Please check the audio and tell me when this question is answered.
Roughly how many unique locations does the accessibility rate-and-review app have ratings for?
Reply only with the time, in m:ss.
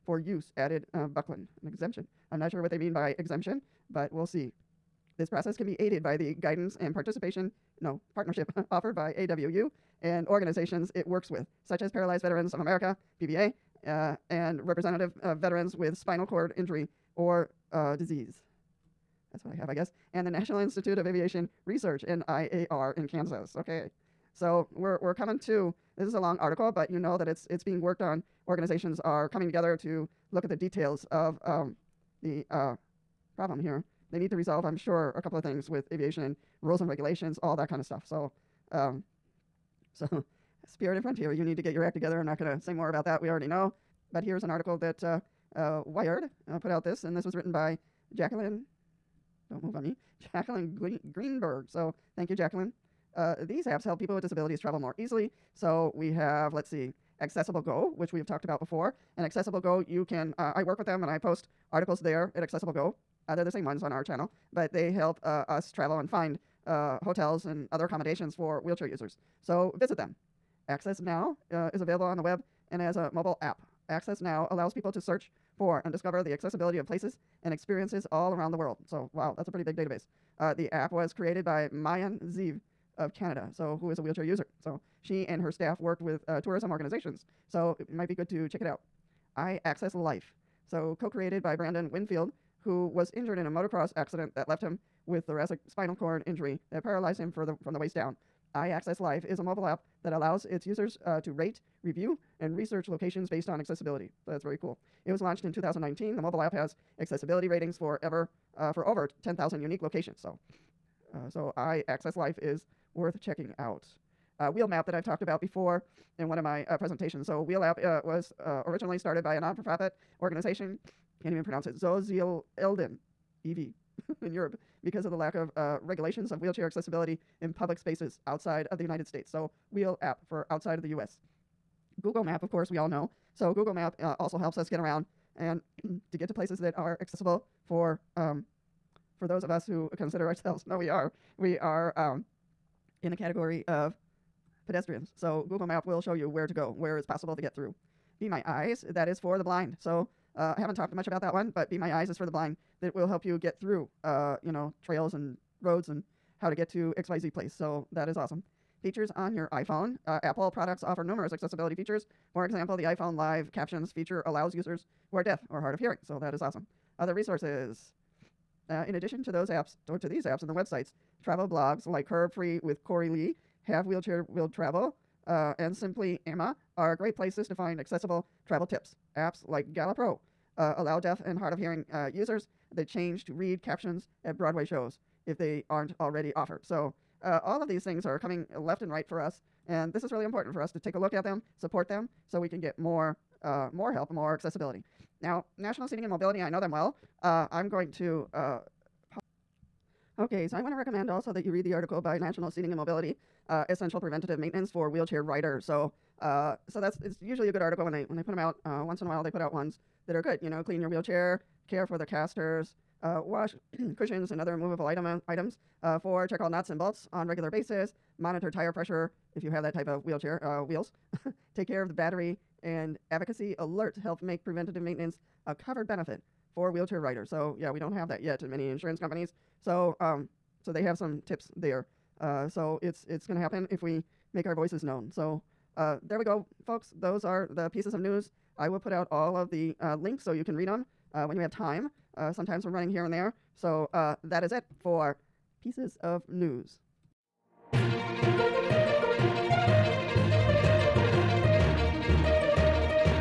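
1:48.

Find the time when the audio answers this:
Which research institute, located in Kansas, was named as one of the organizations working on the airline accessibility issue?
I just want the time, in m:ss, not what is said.
0:20.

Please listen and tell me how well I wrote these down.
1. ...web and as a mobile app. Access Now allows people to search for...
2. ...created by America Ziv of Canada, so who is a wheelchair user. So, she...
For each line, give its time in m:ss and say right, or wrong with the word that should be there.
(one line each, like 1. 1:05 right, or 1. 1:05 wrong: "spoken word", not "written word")
1. 1:12 right
2. 1:21 wrong: "Maayan", not "America".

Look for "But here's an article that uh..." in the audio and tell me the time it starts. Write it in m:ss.
0:44.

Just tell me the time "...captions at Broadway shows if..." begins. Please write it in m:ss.
3:03.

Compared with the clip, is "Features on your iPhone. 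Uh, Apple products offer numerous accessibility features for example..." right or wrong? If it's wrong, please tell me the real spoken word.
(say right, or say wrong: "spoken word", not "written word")
right.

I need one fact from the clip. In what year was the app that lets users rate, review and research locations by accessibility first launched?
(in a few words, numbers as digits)
2019.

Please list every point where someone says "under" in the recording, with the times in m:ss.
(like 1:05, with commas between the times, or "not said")
not said.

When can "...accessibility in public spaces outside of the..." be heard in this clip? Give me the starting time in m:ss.
2:06.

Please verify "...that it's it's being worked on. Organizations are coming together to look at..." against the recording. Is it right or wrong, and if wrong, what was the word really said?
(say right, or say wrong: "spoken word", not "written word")
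right.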